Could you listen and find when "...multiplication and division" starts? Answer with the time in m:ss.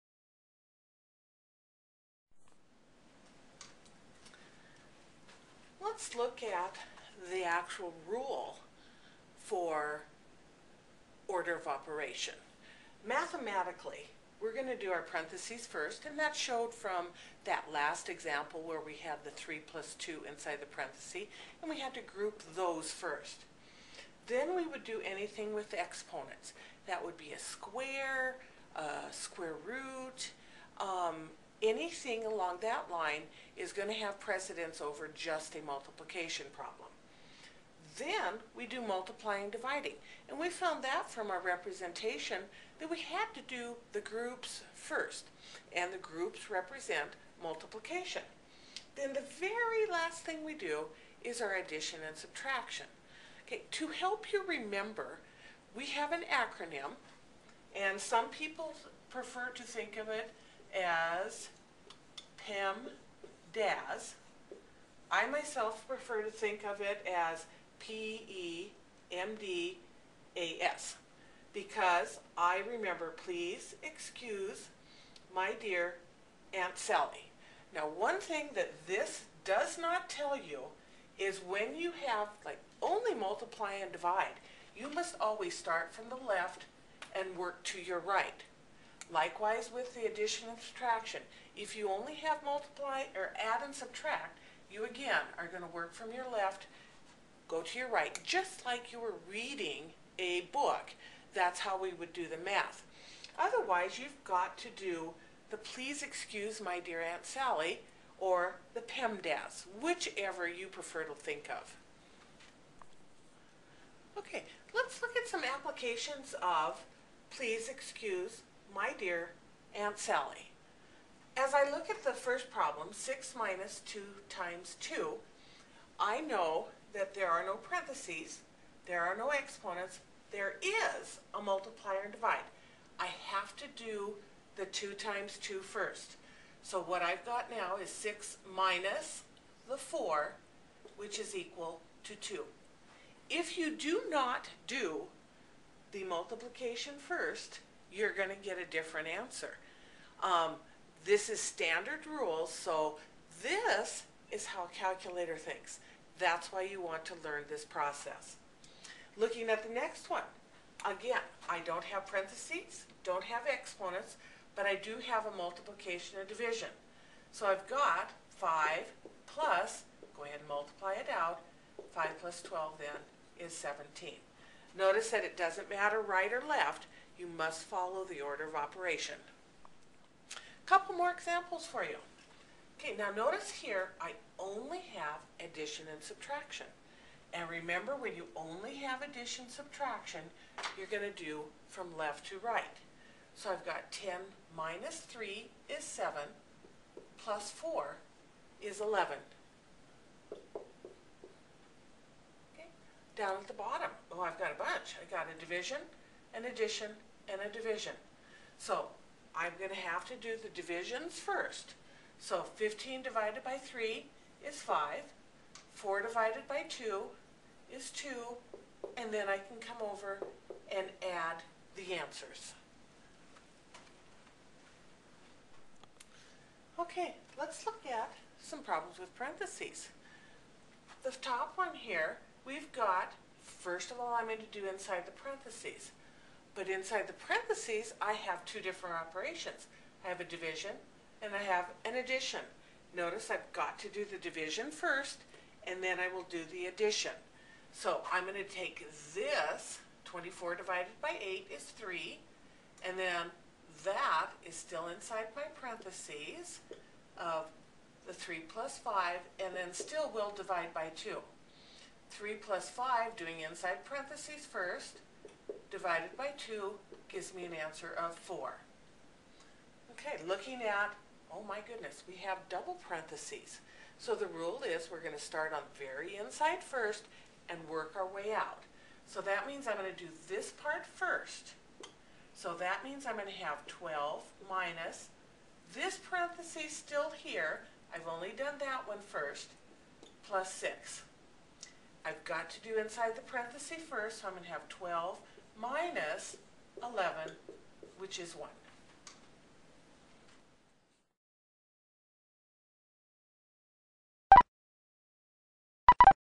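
2:45.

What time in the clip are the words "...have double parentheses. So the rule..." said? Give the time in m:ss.
4:32.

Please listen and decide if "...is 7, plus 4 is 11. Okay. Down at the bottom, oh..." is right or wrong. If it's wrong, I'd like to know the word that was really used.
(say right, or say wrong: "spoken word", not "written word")
right.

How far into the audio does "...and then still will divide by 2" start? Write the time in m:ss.
4:19.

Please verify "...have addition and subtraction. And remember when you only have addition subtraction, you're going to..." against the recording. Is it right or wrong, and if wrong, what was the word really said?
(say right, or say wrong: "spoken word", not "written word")
right.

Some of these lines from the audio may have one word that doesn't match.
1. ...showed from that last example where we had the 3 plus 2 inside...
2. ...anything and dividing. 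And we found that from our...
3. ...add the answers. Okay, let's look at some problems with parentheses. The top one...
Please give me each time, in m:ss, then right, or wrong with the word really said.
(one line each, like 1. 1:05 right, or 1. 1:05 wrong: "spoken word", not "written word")
1. 0:16 right
2. 0:38 wrong: "multiplying", not "anything"
3. 3:41 right.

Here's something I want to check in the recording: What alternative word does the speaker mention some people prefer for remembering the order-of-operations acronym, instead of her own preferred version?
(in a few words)
Pam.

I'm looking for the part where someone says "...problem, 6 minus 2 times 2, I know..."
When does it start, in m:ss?
2:02.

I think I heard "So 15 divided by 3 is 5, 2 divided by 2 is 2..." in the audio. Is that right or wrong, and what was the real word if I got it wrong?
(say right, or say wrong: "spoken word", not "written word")
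wrong: "4", not "2".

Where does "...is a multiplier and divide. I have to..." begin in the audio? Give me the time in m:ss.
2:10.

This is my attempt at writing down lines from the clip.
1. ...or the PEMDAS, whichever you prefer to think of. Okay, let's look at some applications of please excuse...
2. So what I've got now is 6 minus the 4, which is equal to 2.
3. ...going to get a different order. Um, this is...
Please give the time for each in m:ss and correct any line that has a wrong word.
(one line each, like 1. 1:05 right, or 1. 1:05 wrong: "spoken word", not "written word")
1. 1:48 right
2. 2:16 right
3. 2:28 wrong: "answer", not "order".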